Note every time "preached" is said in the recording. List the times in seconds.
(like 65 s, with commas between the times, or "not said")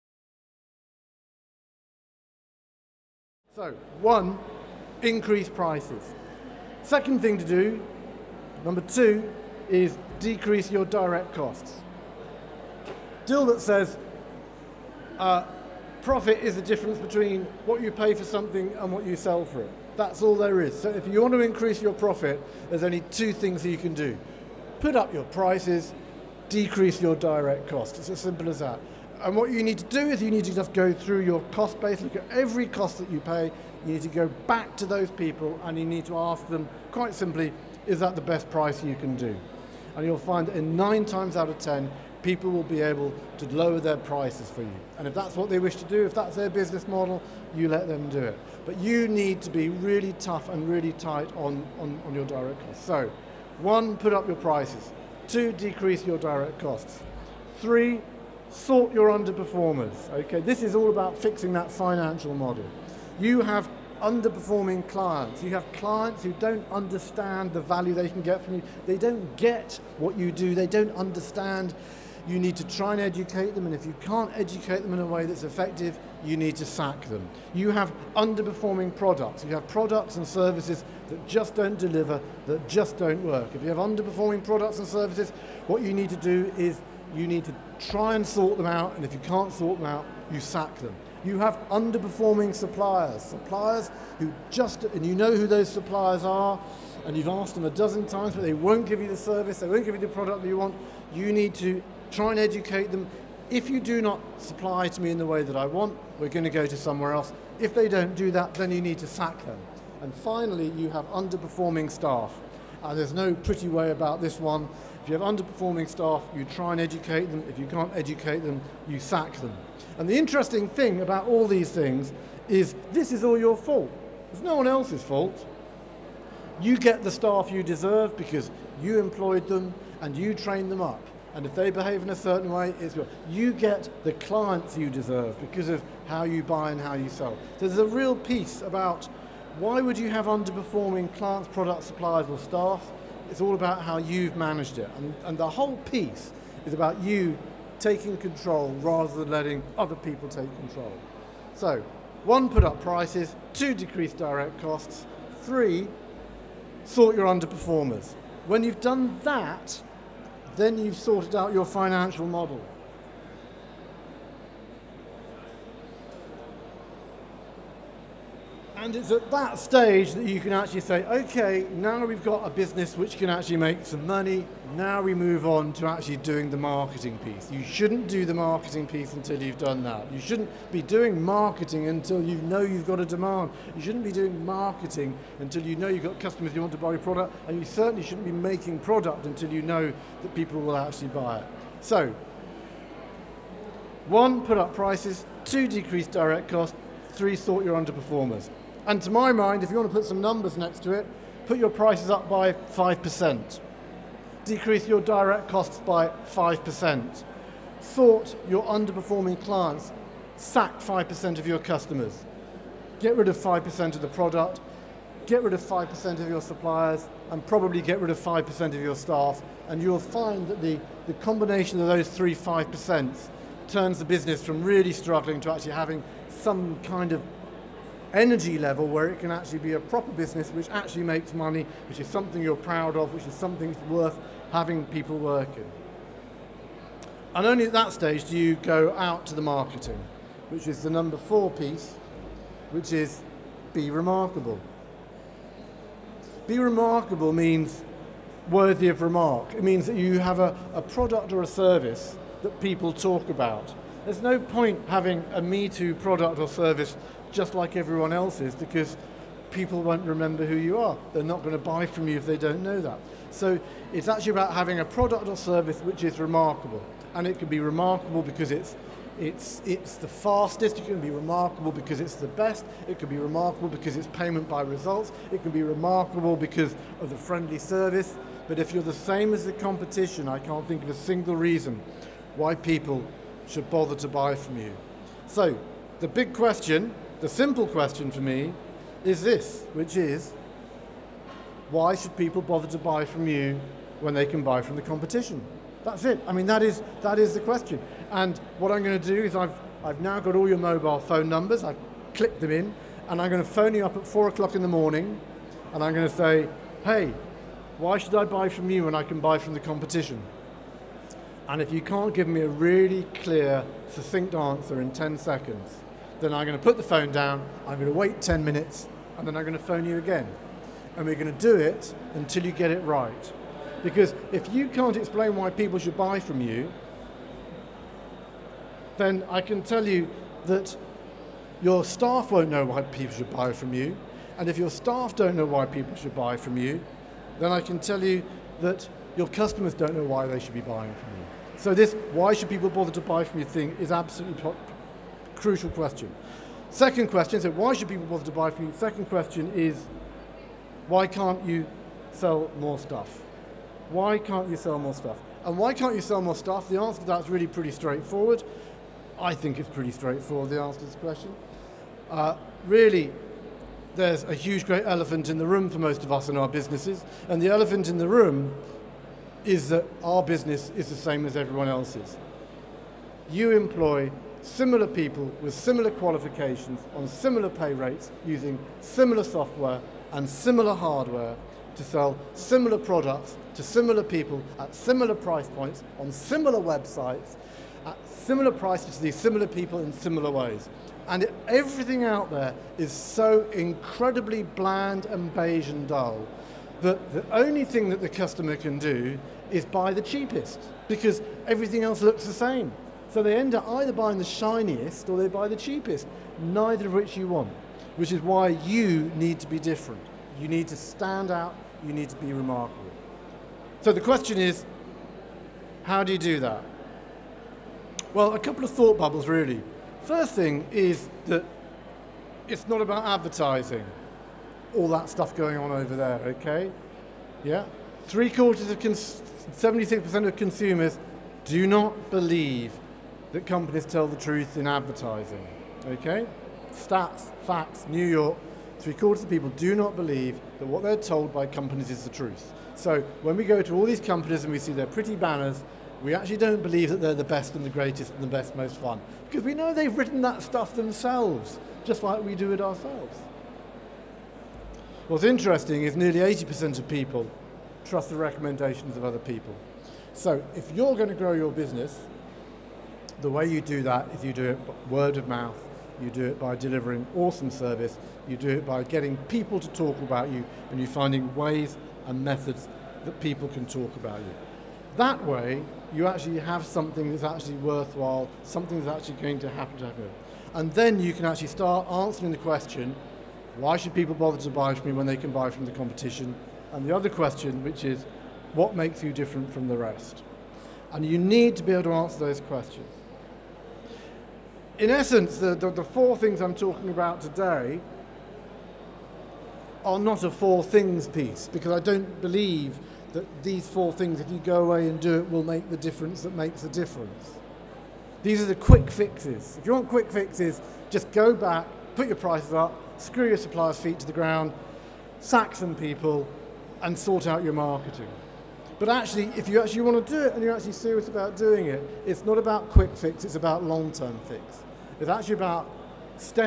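not said.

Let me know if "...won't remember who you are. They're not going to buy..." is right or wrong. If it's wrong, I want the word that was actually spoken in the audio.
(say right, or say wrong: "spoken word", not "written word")
right.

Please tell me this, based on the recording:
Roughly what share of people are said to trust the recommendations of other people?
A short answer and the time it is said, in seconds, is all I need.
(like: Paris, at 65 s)
80%, at 456 s.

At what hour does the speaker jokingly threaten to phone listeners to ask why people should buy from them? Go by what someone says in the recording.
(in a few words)
4 o'clock in the morning.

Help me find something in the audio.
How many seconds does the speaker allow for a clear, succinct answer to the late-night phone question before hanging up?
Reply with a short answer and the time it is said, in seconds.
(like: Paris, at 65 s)
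10 seconds, at 314 s.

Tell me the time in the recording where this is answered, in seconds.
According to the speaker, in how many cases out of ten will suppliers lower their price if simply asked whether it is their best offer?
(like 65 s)
40 s.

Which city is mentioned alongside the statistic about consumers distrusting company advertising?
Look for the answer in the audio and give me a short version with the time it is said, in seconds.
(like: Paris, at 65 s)
New York, at 437 s.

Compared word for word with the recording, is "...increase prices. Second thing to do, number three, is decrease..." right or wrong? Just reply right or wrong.
wrong.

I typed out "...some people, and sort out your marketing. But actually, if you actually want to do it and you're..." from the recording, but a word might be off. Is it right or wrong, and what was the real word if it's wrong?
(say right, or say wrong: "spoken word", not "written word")
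right.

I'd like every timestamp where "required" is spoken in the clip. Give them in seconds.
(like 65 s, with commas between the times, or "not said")
not said.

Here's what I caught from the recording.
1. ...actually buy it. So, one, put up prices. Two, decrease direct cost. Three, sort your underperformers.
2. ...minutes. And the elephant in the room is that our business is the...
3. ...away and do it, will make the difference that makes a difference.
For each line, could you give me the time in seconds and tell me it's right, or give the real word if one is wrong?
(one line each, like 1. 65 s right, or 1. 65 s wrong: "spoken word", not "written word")
1. 190 s right
2. 366 s wrong: "businesses", not "minutes"
3. 504 s right.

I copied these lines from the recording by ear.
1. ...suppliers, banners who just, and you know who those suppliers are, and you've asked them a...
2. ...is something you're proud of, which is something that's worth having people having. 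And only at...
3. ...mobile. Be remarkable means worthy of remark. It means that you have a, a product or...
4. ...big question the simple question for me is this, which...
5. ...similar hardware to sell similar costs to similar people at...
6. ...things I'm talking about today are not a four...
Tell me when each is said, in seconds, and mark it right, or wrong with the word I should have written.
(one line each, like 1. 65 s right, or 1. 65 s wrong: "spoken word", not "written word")
1. 92 s wrong: "suppliers", not "banners"
2. 231 s wrong: "working", not "having"
3. 243 s wrong: "remarkable", not "mobile"
4. 286 s right
5. 380 s wrong: "products", not "costs"
6. 496 s right.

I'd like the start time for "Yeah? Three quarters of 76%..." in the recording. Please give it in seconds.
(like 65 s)
427 s.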